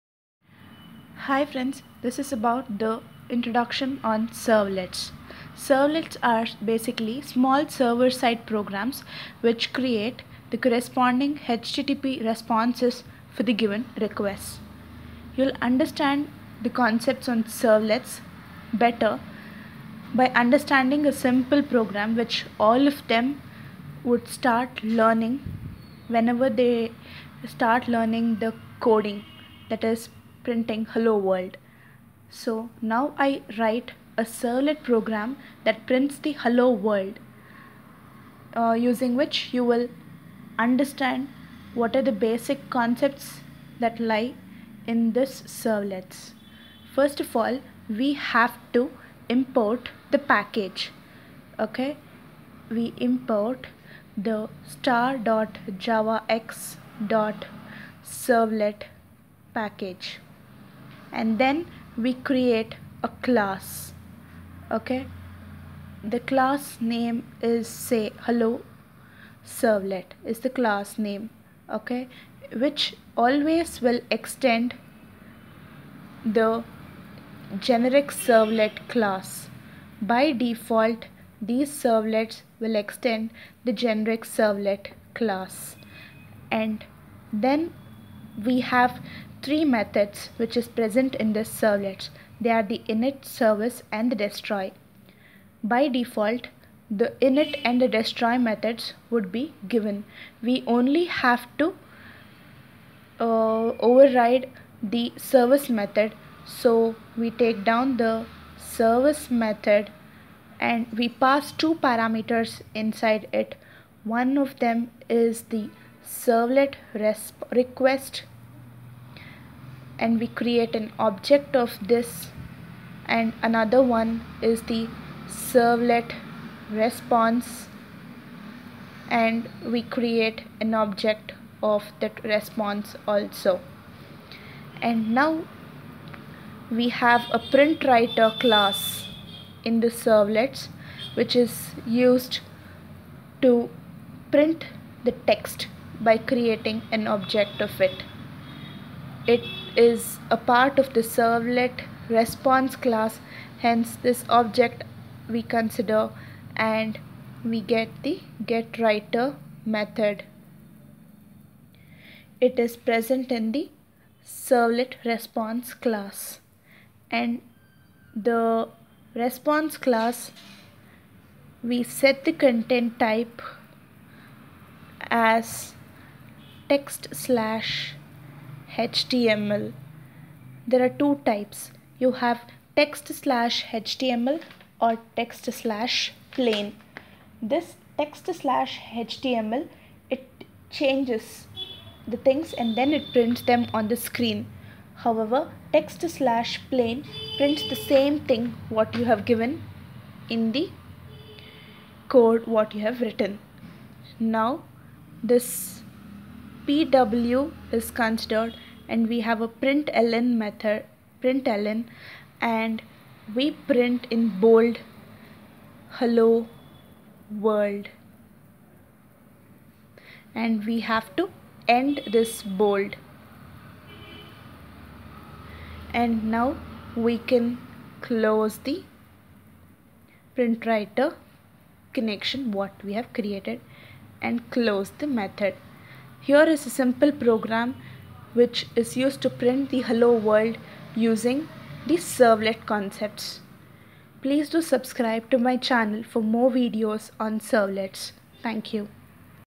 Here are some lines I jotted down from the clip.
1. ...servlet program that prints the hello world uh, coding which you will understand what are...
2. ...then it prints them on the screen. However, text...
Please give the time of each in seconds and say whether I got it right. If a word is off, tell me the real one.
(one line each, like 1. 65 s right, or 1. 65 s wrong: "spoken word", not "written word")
1. 34 s wrong: "using", not "coding"
2. 192 s right.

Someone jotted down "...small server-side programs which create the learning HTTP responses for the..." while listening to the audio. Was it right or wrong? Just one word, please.
wrong.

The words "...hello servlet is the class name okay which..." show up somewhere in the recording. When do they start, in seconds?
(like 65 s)
68 s.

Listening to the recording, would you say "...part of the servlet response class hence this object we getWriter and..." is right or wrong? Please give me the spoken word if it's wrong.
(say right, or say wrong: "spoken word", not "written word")
wrong: "consider", not "getWriter".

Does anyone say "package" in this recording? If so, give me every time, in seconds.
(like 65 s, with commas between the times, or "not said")
50 s, 59 s.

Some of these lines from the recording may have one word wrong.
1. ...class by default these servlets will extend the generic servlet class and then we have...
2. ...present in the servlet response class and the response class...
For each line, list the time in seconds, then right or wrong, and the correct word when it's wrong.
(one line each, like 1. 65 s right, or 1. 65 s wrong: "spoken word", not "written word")
1. 78 s right
2. 162 s right.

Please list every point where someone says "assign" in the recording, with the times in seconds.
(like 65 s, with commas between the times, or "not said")
not said.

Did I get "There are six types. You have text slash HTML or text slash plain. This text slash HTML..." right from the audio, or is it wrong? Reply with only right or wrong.
wrong.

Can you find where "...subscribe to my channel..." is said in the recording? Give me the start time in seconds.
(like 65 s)
244 s.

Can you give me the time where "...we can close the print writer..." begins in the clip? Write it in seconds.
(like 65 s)
226 s.